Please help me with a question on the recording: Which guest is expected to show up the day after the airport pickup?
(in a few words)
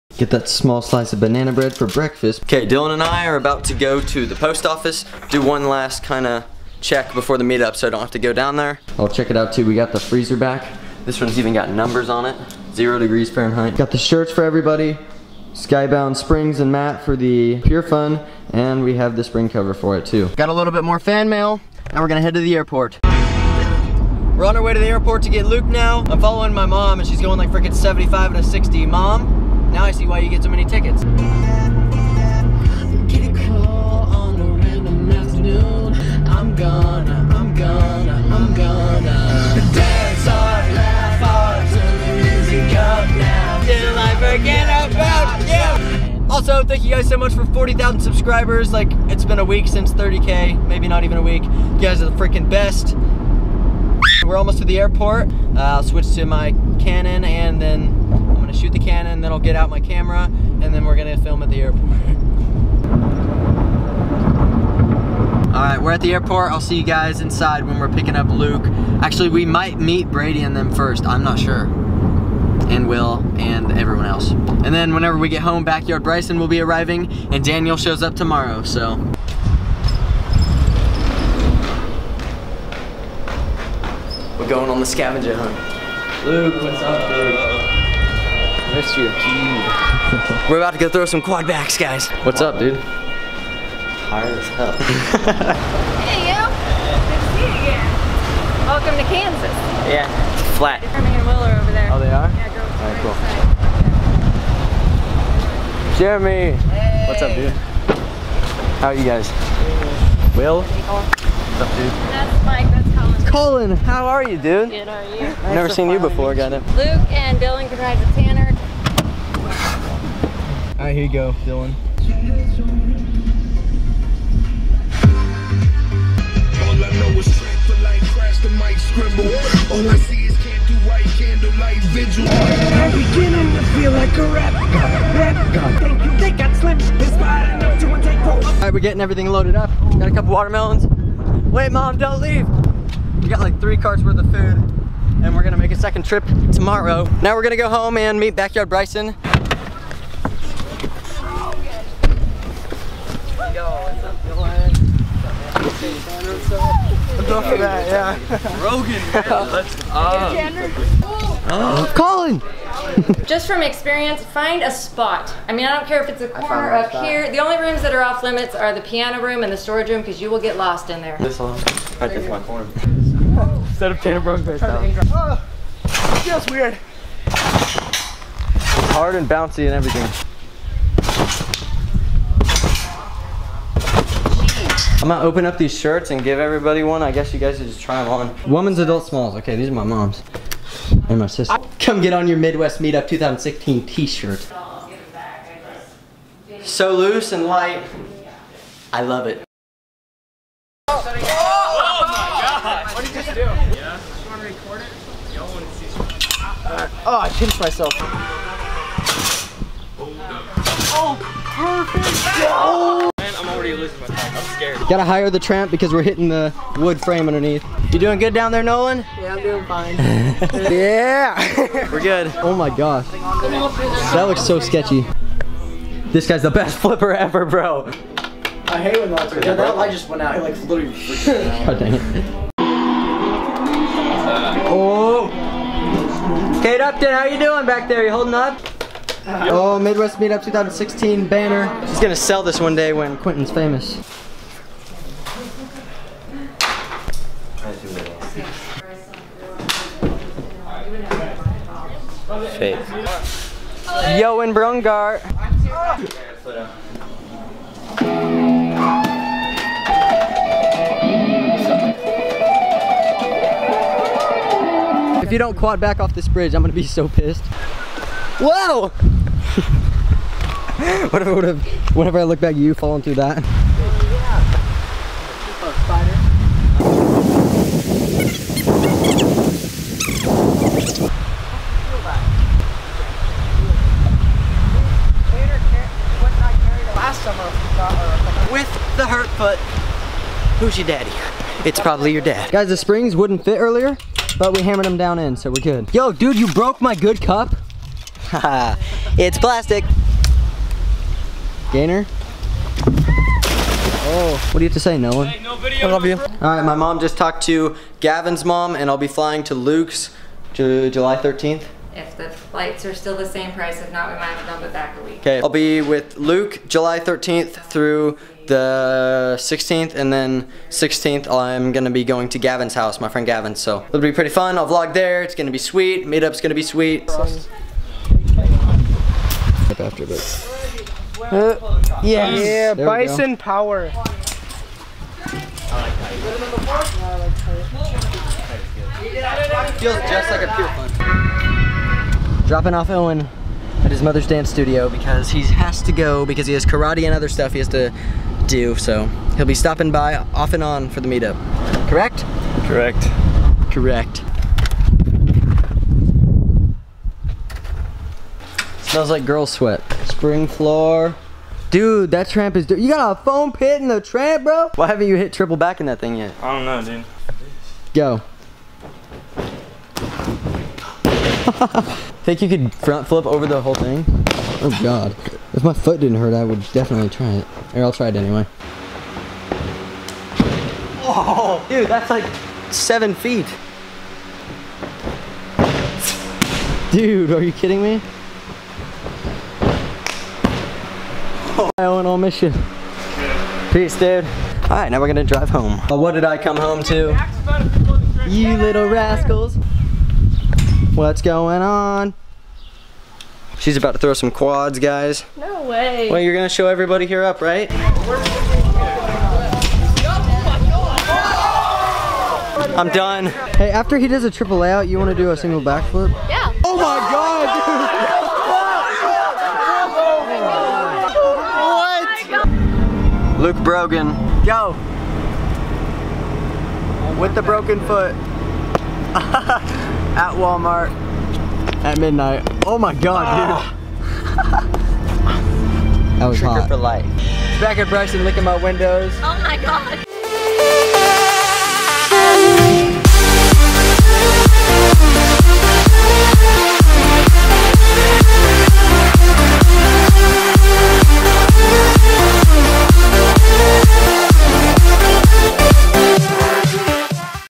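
Daniel.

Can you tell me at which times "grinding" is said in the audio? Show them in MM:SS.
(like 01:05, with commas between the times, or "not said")
not said.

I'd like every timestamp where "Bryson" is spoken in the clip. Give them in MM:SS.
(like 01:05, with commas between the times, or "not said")
01:16, 02:28, 07:17.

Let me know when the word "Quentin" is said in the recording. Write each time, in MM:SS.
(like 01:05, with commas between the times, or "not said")
04:03.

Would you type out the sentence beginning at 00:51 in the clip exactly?
You guys are the freaking best.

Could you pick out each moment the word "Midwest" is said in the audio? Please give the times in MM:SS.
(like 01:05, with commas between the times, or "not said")
03:12, 03:59.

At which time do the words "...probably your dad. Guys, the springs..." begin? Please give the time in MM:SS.
04:51.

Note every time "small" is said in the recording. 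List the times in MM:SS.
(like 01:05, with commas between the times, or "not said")
00:00, 03:09.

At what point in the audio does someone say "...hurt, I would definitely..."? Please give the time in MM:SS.
06:16.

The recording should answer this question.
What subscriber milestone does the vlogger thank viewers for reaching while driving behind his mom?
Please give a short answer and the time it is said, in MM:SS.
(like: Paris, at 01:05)
40,000, at 00:47.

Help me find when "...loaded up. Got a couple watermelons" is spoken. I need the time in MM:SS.
02:19.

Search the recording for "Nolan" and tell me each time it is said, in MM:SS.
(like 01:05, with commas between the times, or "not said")
03:38, 05:04.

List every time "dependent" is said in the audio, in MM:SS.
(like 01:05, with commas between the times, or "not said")
not said.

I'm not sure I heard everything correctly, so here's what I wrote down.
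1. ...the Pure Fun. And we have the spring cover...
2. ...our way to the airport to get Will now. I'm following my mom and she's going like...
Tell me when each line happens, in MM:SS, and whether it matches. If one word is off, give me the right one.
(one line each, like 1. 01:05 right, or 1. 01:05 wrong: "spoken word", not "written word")
1. 00:17 right
2. 00:24 wrong: "Luke", not "Will".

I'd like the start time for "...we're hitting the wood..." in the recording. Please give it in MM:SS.
03:35.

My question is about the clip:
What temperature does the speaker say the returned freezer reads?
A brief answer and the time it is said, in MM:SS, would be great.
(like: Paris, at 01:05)
0 degrees Fahrenheit, at 00:12.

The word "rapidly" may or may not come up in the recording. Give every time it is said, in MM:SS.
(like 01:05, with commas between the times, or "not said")
not said.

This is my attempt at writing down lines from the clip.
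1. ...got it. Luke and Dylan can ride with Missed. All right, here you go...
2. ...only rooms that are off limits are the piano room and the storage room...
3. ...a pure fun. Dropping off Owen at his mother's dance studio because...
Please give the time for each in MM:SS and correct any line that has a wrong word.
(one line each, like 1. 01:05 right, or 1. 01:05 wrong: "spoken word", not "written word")
1. 01:56 wrong: "Tanner", not "Missed"
2. 02:47 right
3. 05:40 right.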